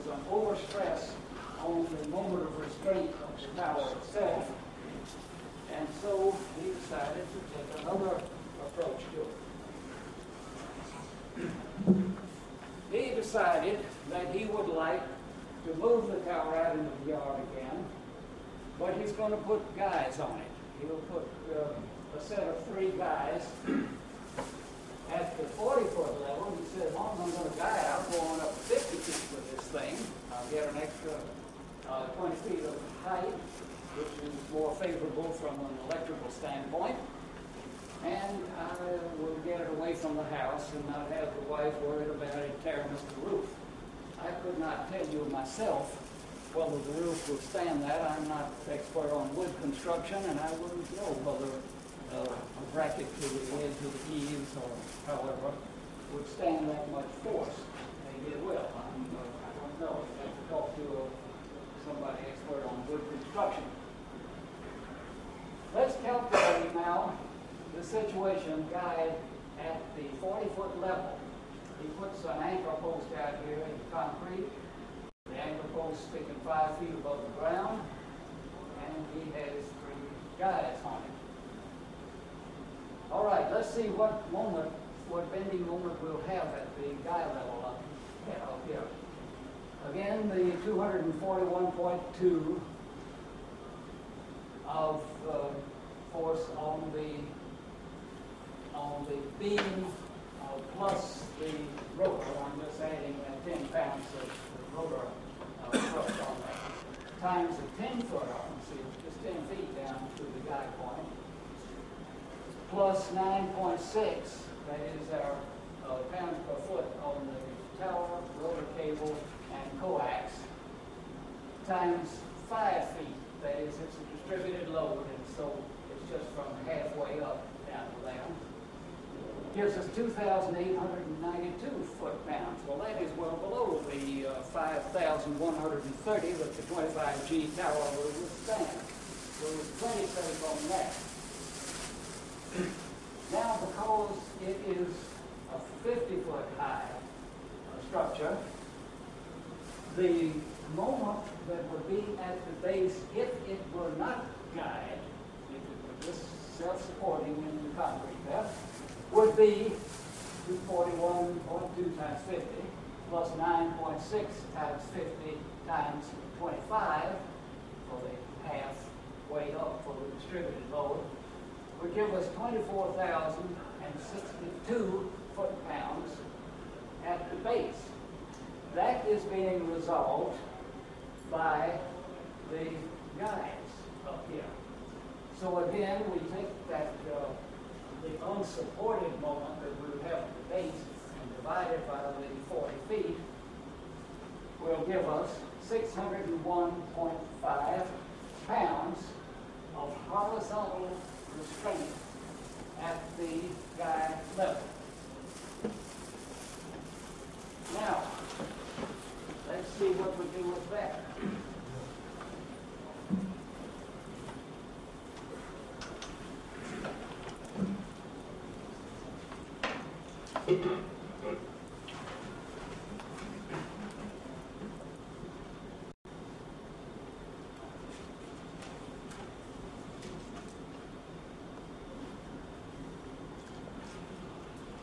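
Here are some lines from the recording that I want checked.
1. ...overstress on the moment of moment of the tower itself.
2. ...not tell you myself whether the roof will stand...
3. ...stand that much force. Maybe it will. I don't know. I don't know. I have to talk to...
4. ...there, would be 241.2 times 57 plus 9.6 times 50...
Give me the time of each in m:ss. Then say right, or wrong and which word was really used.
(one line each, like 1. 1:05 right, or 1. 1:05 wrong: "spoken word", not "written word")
1. 0:00 wrong: "restraint", not "moment"
2. 0:44 right
3. 0:56 right
4. 2:38 wrong: "50", not "57".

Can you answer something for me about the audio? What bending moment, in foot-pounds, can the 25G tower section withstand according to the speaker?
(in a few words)
5,130.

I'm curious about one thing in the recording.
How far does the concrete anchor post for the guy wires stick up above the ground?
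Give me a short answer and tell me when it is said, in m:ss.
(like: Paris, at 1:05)
5 feet, at 1:16.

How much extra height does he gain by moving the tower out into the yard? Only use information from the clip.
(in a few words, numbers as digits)
20 feet.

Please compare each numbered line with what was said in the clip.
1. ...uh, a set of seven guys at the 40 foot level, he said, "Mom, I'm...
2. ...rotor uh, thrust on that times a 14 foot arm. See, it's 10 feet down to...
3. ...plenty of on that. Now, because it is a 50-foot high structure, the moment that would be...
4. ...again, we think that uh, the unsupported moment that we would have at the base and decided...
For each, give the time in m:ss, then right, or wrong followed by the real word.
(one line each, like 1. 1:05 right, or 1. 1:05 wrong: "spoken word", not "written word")
1. 0:21 wrong: "three", not "seven"
2. 1:44 wrong: "10", not "14"
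3. 2:19 right
4. 3:05 wrong: "divided", not "decided".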